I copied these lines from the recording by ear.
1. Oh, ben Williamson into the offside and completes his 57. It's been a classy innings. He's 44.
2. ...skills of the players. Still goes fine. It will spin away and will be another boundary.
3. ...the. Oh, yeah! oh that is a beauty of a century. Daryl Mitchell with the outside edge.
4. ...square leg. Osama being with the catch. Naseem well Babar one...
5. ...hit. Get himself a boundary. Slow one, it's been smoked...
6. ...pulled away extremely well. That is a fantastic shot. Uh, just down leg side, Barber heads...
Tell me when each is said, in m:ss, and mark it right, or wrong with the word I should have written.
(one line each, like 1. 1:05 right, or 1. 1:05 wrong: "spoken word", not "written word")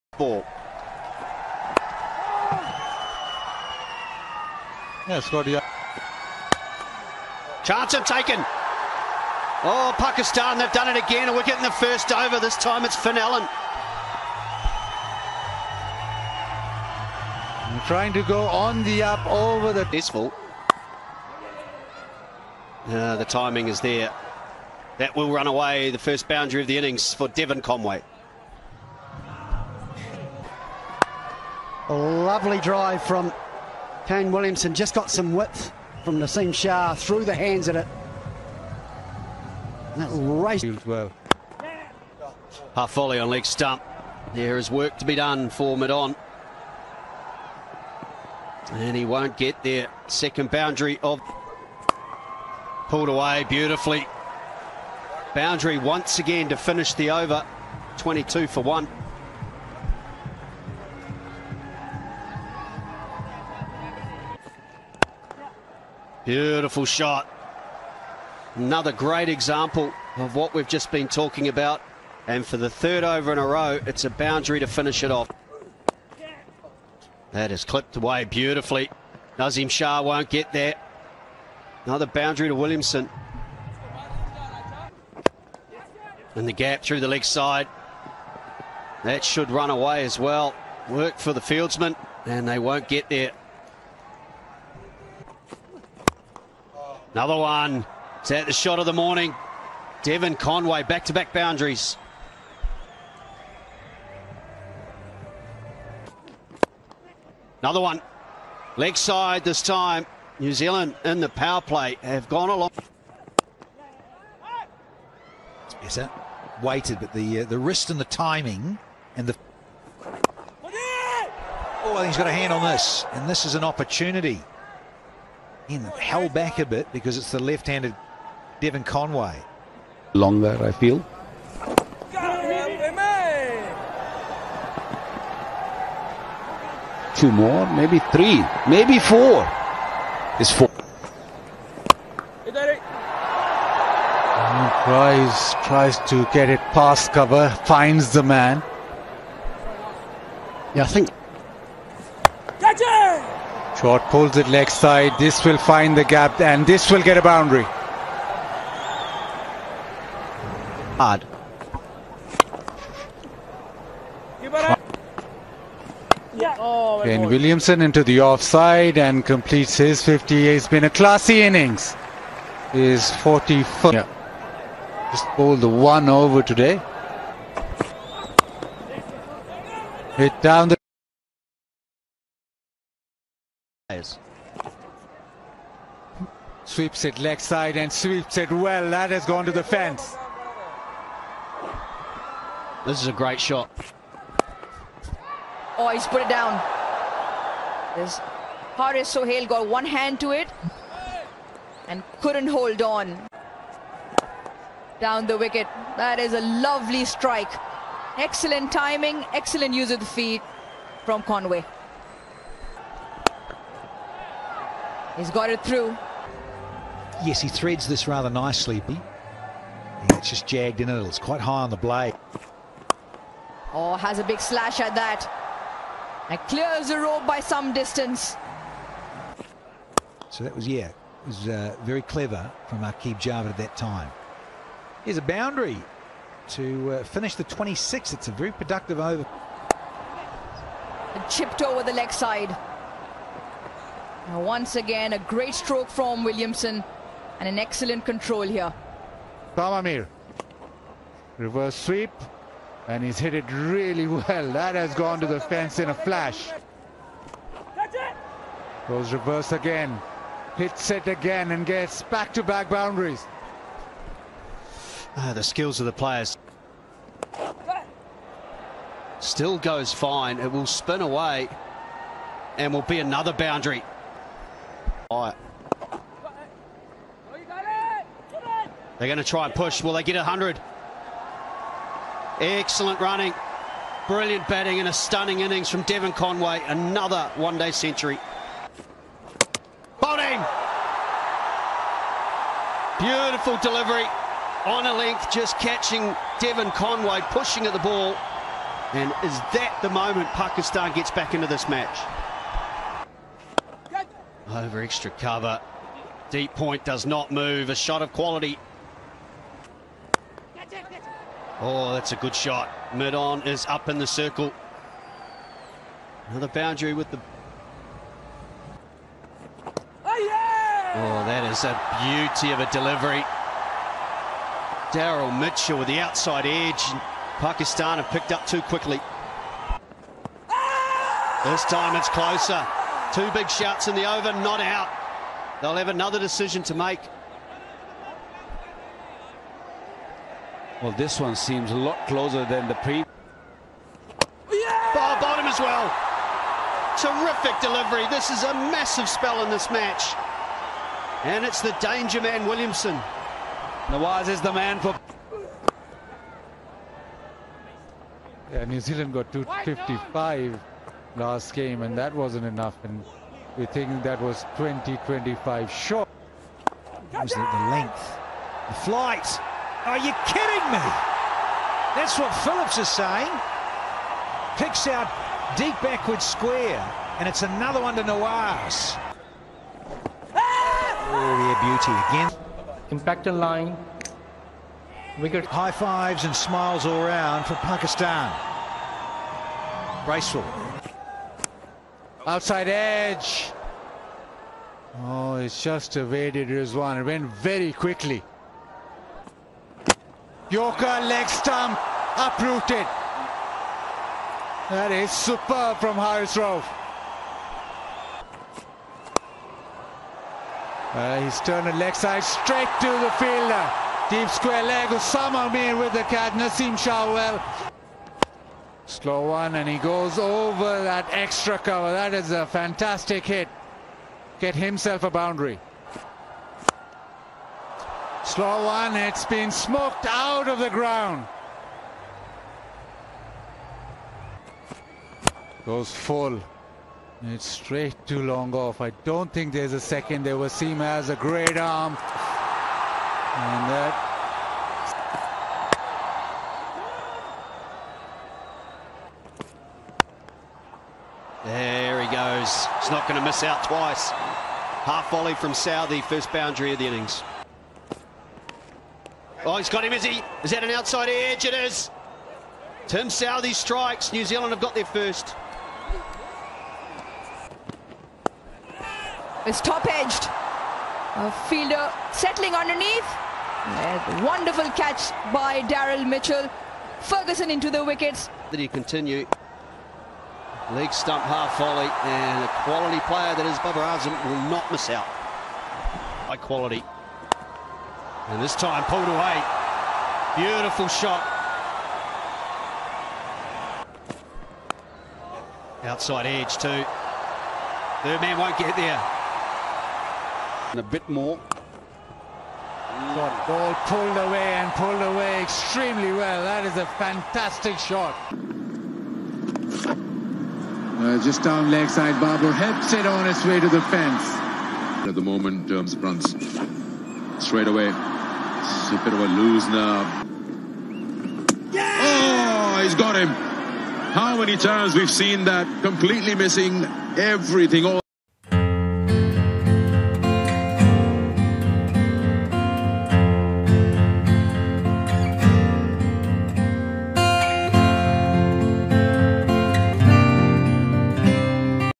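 1. 2:46 wrong: "50", not "57"
2. 4:25 right
3. 5:17 wrong: "delivery", not "century"
4. 6:54 wrong: "Slow", not "Babar"
5. 7:03 right
6. 8:24 right.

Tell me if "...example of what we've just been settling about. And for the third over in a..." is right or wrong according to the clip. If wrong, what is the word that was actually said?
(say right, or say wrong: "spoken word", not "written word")
wrong: "talking", not "settling".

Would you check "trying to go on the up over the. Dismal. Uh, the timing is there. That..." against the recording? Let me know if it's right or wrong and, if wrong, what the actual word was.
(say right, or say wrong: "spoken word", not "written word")
right.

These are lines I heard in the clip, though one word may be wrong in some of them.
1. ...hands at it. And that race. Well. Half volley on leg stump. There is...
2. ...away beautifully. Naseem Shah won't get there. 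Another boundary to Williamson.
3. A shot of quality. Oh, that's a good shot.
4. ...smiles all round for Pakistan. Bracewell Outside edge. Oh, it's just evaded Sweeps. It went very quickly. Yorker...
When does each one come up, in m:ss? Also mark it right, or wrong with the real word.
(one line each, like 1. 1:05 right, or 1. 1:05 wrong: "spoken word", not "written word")
1. 0:37 right
2. 1:17 right
3. 5:07 right
4. 6:26 wrong: "Rizwan", not "Sweeps".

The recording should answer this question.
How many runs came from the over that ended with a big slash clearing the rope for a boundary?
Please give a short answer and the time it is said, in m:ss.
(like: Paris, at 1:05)
26, at 3:57.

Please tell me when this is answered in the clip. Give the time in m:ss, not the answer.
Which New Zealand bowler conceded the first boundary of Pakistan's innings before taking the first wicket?
7:42.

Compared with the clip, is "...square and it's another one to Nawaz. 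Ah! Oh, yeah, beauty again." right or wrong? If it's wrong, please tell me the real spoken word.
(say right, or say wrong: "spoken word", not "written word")
right.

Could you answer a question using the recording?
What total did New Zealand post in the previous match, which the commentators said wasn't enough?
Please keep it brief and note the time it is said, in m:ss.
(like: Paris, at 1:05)
255, at 5:59.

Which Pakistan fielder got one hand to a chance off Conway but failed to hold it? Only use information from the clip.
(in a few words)
Haris Sohail.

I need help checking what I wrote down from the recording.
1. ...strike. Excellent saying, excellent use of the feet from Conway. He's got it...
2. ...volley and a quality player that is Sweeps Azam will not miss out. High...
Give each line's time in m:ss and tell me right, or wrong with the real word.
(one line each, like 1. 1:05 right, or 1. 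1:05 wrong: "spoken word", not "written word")
1. 3:27 wrong: "timing", not "saying"
2. 8:01 wrong: "Babar", not "Sweeps".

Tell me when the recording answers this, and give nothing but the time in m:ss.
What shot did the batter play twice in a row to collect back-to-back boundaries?
4:11.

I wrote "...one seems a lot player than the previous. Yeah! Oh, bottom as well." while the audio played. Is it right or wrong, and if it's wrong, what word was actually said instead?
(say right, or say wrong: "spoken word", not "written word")
wrong: "closer", not "player".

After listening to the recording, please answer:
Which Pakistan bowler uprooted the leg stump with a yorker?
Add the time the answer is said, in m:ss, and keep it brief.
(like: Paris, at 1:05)
Haris Rauf, at 6:45.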